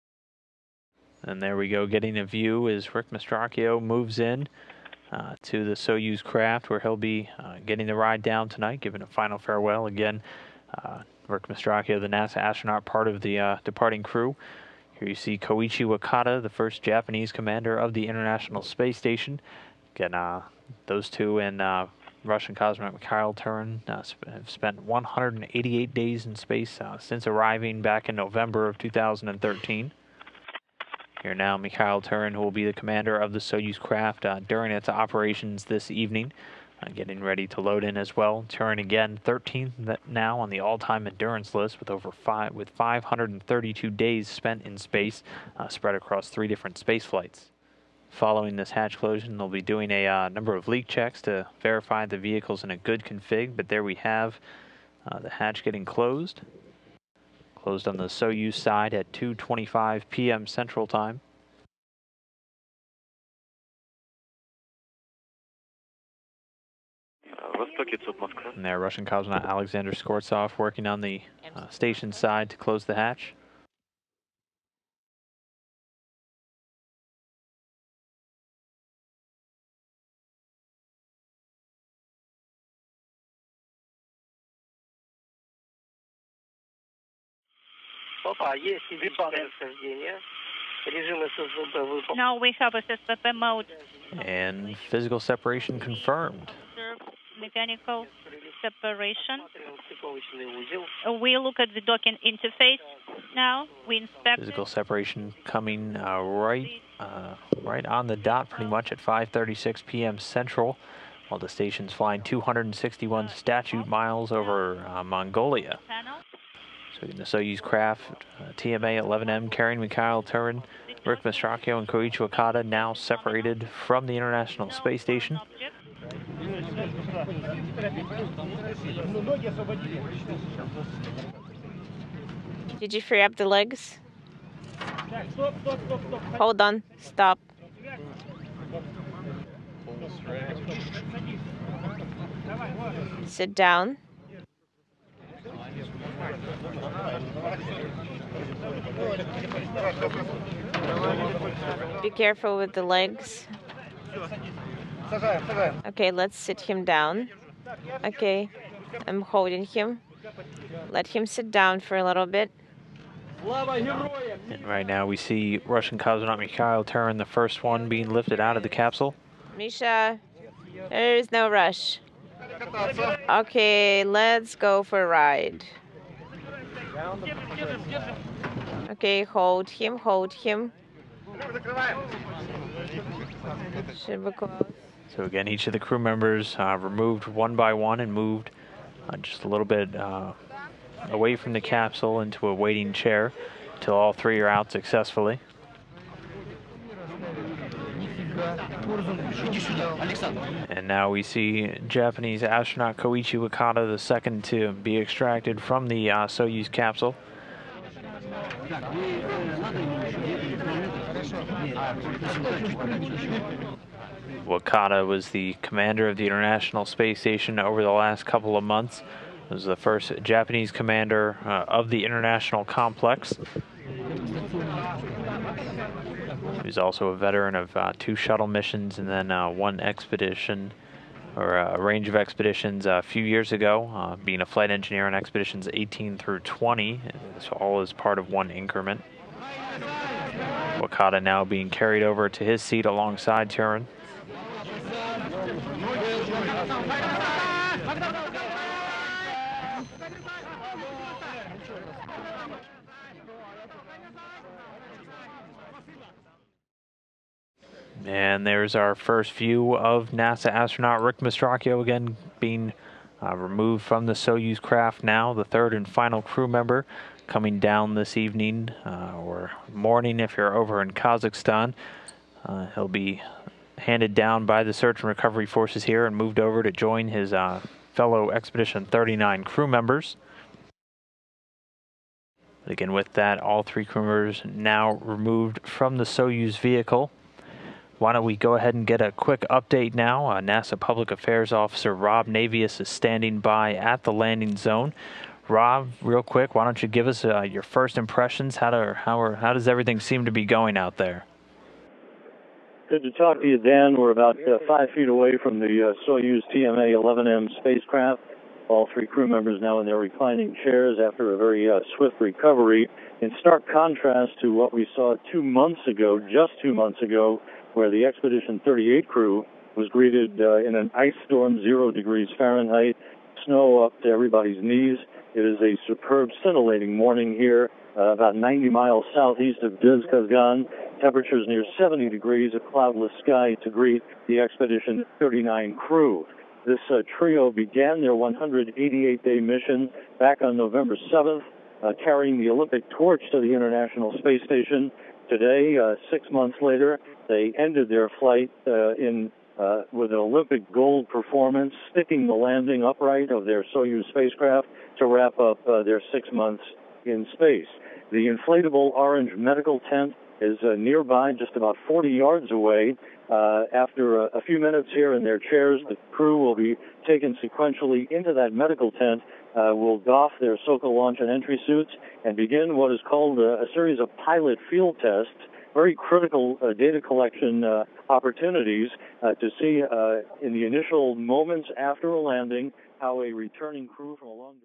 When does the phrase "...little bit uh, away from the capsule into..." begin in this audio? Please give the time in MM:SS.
03:09.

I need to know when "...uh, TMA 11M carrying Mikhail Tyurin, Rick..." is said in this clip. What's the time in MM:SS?
01:58.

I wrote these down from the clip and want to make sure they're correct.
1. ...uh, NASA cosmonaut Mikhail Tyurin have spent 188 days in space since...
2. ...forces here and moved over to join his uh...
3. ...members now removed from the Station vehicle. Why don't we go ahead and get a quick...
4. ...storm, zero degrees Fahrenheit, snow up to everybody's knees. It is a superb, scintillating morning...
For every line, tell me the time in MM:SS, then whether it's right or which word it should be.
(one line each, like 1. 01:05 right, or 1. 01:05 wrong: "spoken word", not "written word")
1. 00:21 wrong: "Russian", not "NASA"
2. 04:35 right
3. 04:44 wrong: "Soyuz", not "Station"
4. 05:21 right.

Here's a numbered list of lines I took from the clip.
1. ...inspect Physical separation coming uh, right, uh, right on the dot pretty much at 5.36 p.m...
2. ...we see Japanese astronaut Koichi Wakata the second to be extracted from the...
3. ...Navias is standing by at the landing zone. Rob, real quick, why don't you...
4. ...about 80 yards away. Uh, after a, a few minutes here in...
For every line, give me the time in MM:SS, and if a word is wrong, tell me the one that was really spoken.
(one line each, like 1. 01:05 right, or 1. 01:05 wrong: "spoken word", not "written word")
1. 01:43 right
2. 03:21 right
3. 04:52 right
4. 06:01 wrong: "40", not "80".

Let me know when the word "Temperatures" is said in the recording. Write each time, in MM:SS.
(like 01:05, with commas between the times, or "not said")
05:31.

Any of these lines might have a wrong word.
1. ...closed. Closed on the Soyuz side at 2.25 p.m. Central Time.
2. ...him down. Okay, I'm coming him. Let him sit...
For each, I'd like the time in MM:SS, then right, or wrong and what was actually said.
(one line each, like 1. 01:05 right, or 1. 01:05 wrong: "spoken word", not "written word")
1. 00:55 right
2. 02:36 wrong: "holding", not "coming".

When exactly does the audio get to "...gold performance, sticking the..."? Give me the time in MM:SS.
05:50.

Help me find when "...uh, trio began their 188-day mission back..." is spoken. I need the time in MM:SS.
05:36.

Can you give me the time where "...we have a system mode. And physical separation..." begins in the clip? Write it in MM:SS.
01:32.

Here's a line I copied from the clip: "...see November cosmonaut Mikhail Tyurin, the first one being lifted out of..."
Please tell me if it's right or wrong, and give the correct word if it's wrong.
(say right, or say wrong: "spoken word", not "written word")
wrong: "Russian", not "November".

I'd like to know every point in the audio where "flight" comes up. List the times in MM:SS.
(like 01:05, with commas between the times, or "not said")
00:47, 03:54, 05:48.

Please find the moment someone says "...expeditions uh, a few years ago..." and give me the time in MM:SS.
03:52.